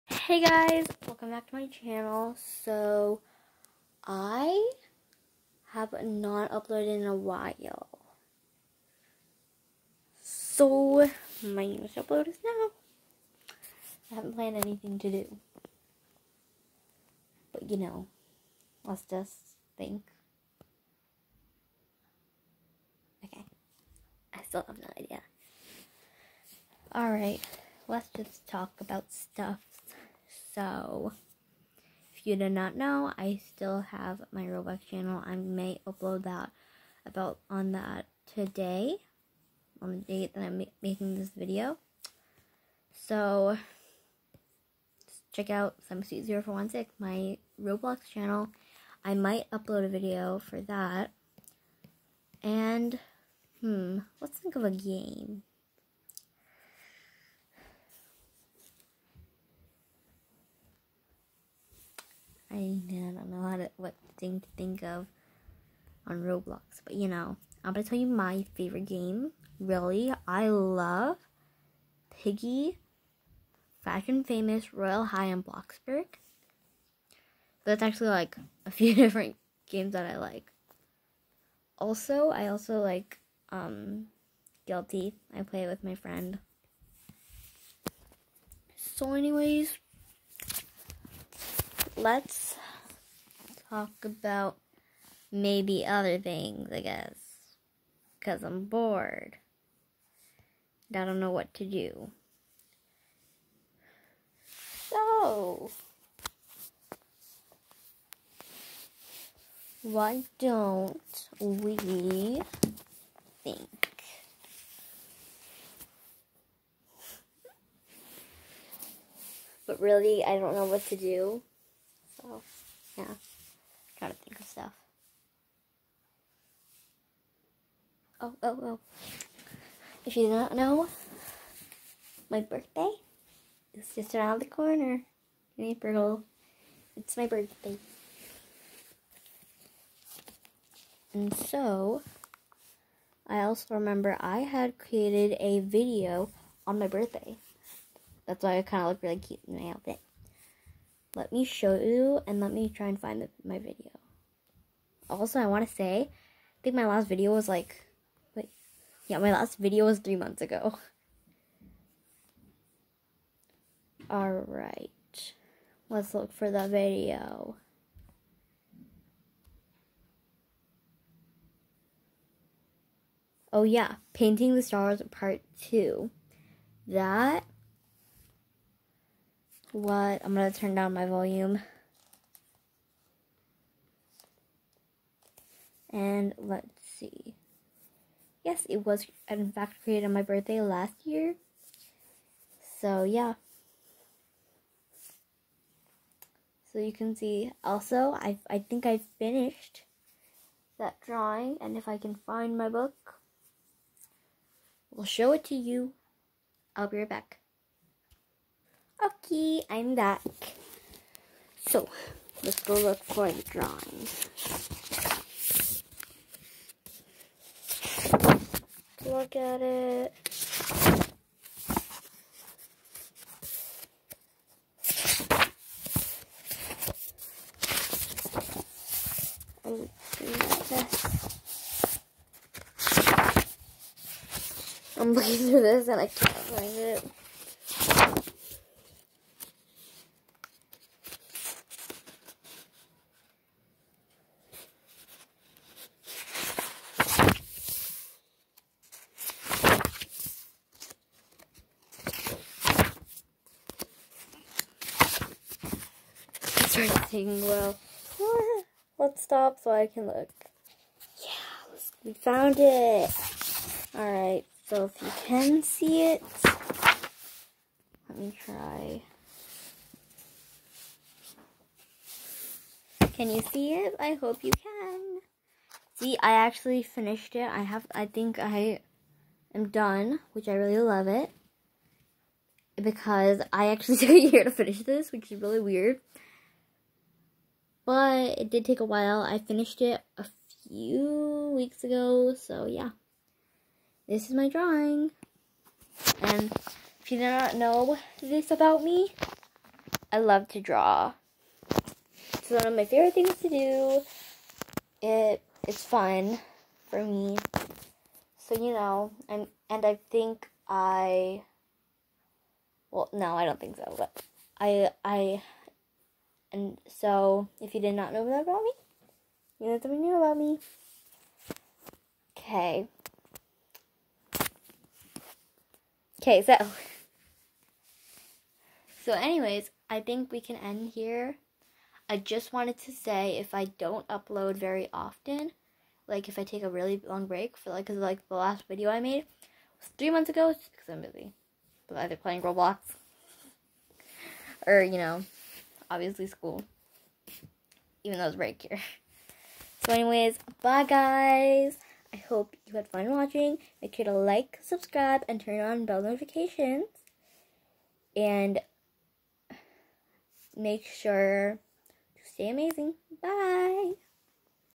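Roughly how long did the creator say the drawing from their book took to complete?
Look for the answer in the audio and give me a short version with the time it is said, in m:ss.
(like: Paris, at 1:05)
a year, at 4:44.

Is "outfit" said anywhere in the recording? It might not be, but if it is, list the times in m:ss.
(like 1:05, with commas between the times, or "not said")
2:29.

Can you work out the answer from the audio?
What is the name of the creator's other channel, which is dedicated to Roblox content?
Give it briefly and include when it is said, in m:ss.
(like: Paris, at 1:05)
SummerSuit0416, at 0:45.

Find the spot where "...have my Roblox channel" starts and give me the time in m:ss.
0:33.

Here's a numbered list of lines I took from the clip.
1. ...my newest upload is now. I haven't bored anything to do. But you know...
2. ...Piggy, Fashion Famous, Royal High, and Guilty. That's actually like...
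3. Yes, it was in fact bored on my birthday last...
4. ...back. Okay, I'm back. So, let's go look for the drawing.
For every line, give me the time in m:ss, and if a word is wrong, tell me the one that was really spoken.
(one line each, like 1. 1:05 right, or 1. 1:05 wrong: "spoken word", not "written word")
1. 0:11 wrong: "planned", not "bored"
2. 1:12 wrong: "Bloxburg", not "Guilty"
3. 3:08 wrong: "created", not "bored"
4. 3:27 right.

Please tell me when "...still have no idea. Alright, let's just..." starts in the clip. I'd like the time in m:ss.
0:24.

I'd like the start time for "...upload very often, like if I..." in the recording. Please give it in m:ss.
5:34.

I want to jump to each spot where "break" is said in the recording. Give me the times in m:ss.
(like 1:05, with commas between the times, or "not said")
5:37.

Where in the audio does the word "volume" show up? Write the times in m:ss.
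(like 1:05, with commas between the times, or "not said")
3:01.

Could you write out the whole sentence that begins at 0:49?
I might upload a video for that.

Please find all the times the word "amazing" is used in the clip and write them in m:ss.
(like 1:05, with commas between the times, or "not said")
6:02.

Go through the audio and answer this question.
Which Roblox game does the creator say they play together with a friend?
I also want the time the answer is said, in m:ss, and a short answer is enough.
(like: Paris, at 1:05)
Guilty, at 1:24.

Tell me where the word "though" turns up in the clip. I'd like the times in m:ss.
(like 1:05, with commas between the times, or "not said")
5:48.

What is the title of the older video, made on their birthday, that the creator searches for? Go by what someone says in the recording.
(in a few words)
Painting the Stars Part 2.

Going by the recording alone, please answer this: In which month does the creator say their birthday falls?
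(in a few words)
April.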